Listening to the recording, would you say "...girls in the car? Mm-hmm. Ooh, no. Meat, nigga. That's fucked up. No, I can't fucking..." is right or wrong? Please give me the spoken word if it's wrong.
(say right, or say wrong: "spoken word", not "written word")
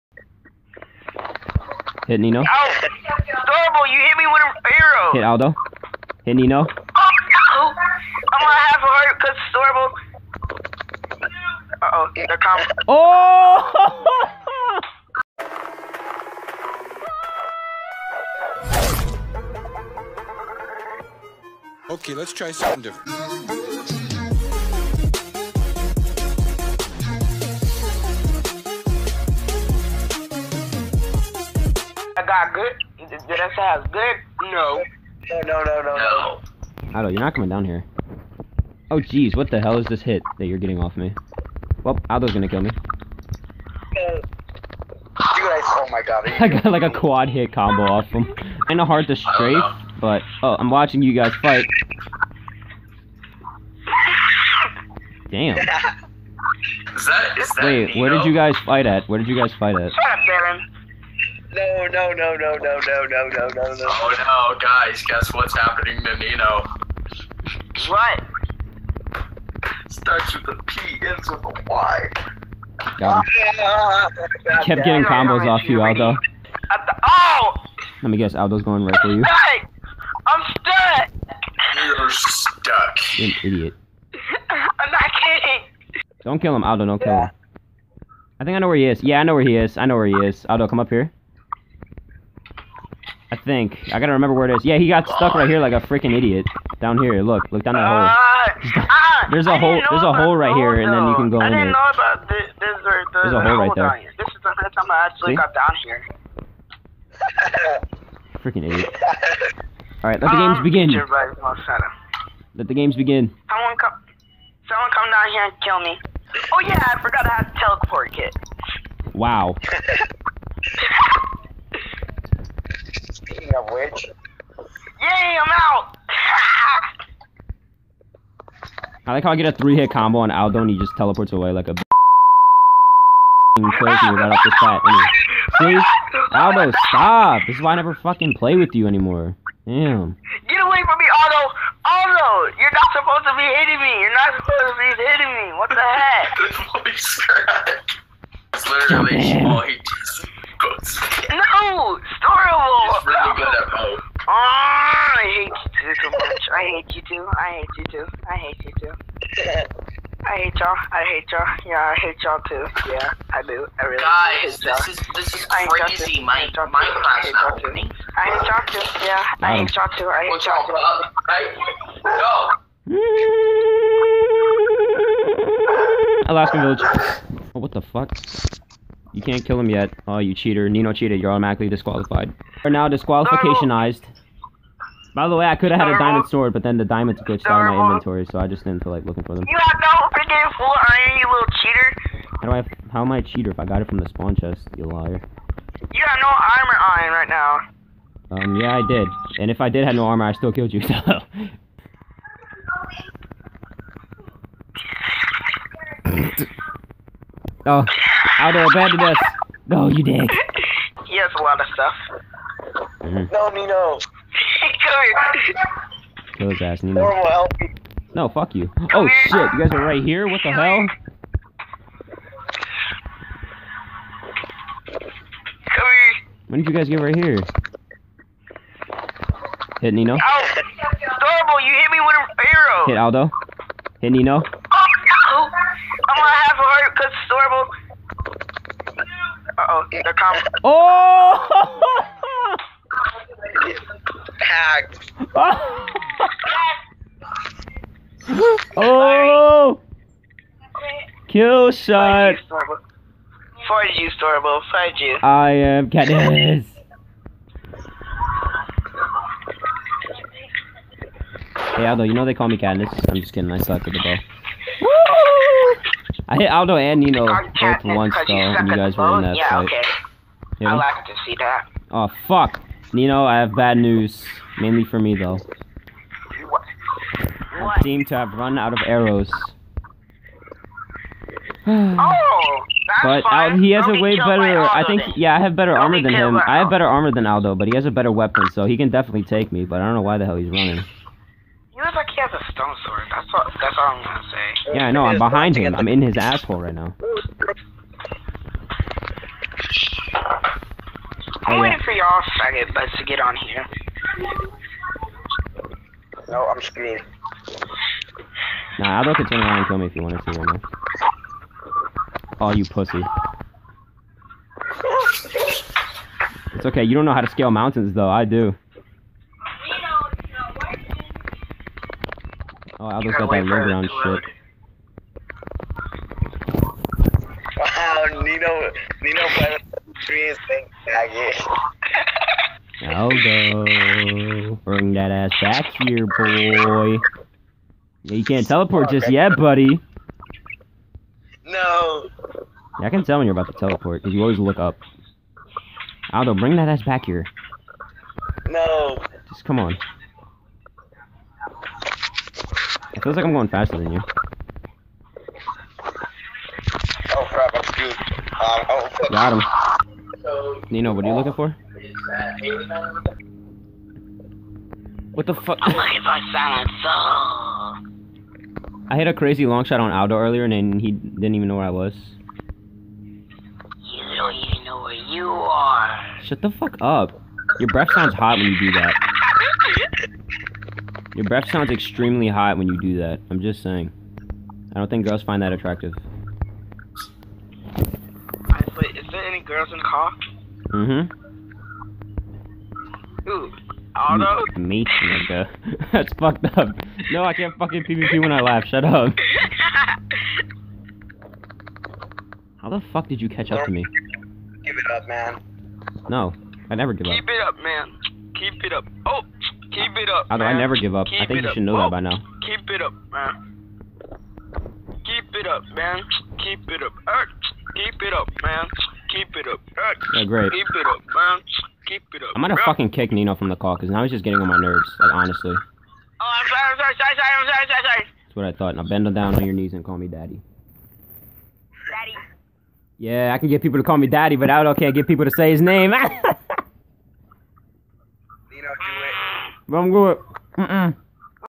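right.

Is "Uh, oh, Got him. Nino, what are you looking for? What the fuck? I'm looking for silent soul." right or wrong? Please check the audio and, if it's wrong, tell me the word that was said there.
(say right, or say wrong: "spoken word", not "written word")
right.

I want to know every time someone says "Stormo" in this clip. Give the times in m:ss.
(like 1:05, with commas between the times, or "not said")
4:14.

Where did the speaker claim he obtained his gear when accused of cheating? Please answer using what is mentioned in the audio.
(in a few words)
The spawn chest.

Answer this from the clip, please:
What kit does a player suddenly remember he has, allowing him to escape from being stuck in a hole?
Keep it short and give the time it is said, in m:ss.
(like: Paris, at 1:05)
Teleport kit, at 1:57.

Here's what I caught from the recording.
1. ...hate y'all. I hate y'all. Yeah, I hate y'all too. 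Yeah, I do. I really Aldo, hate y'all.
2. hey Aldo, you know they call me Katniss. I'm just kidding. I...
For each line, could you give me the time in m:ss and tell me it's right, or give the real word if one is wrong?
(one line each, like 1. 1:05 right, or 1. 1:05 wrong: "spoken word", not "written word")
1. 2:40 wrong: "Guys", not "Aldo"
2. 4:21 right.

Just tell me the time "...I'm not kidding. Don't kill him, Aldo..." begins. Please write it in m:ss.
1:24.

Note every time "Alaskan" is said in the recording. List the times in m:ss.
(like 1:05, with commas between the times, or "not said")
2:56.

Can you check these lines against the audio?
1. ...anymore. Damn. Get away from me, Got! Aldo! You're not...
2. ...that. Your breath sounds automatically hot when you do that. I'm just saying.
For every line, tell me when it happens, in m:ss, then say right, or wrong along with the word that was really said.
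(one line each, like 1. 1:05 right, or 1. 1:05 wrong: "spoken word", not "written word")
1. 2:18 wrong: "Aldo", not "Got"
2. 6:18 wrong: "extremely", not "automatically".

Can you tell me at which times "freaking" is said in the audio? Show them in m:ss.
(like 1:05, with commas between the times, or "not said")
1:35, 1:48, 3:10.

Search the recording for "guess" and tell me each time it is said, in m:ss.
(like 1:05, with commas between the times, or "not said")
1:05, 1:18.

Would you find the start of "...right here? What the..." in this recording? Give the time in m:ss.
3:39.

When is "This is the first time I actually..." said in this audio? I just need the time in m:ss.
1:44.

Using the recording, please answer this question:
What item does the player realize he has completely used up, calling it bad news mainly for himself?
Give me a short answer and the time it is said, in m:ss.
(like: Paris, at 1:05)
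Arrows, at 4:38.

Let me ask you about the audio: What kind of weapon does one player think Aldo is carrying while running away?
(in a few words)
Stone sword.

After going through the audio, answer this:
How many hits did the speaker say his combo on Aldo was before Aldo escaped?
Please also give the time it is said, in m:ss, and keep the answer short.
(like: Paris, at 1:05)
3, at 2:09.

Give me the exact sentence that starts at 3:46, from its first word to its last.
When did you guys get right here?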